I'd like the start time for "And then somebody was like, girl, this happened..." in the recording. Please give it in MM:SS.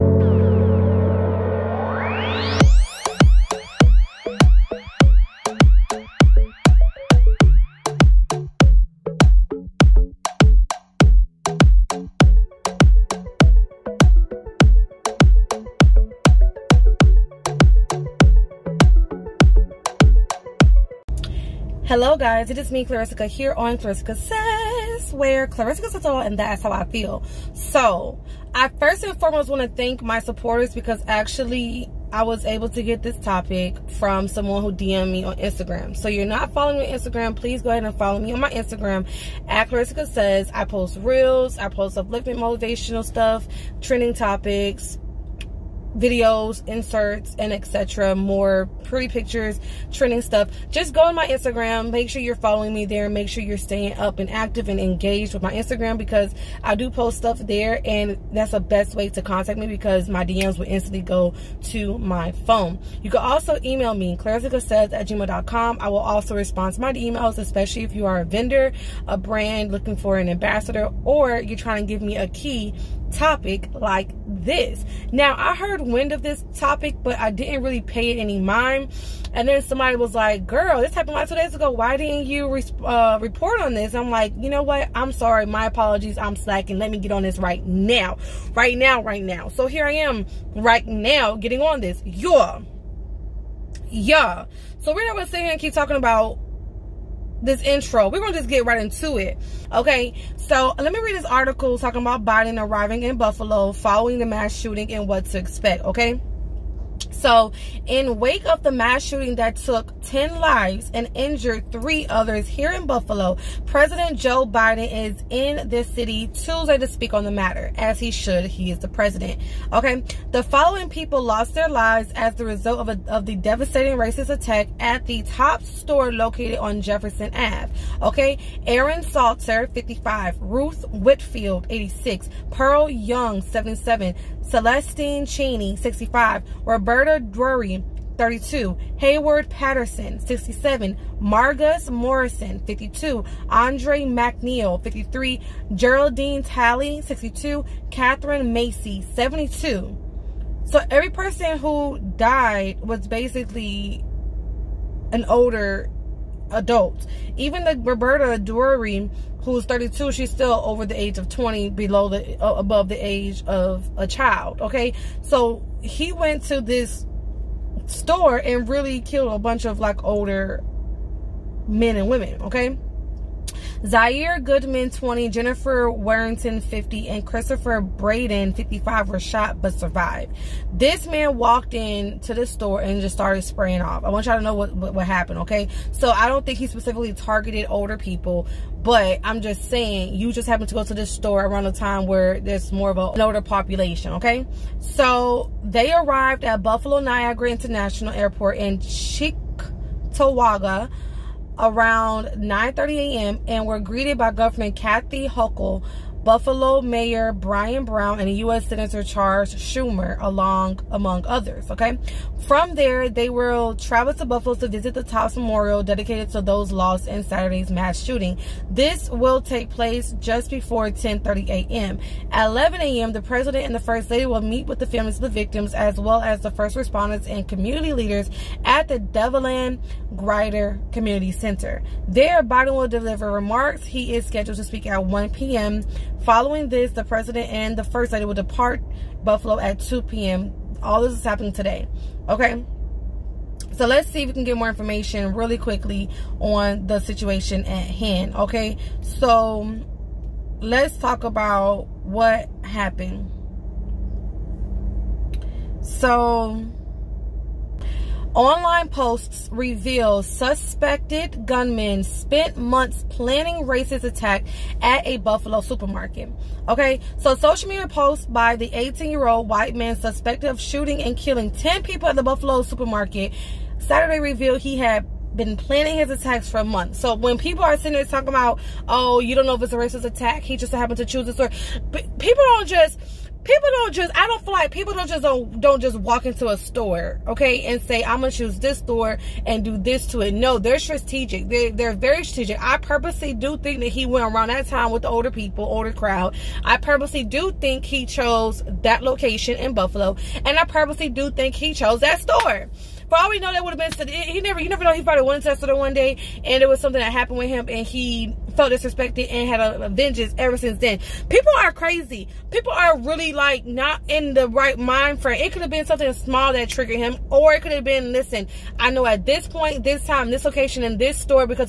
01:19.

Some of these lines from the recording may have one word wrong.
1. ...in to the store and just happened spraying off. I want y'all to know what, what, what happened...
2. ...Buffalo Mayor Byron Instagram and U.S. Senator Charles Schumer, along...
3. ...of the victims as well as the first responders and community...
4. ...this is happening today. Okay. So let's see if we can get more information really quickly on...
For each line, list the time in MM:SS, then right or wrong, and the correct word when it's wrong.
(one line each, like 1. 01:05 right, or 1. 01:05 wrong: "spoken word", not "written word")
1. 03:01 wrong: "started", not "happened"
2. 03:26 wrong: "Brown", not "Instagram"
3. 03:45 right
4. 04:01 right.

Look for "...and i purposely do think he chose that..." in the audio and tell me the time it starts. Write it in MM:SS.
05:00.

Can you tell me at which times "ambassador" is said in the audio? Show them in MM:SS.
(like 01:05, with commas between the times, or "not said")
01:10.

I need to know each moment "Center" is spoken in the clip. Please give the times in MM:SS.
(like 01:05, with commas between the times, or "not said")
03:51.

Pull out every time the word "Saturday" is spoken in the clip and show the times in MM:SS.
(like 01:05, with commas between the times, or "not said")
03:37, 04:33.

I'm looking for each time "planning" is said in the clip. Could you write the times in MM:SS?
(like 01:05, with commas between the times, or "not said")
04:23, 04:35.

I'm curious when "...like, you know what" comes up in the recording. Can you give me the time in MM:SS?
01:24.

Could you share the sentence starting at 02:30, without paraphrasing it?
So every person who died was basically an older adults.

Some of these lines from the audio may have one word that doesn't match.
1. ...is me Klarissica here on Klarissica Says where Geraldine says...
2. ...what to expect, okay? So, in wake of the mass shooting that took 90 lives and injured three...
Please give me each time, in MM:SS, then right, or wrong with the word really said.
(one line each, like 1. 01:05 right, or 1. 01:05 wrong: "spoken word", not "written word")
1. 00:22 wrong: "Klarissica", not "Geraldine"
2. 01:45 wrong: "10", not "90".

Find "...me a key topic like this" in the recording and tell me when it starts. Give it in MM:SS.
01:12.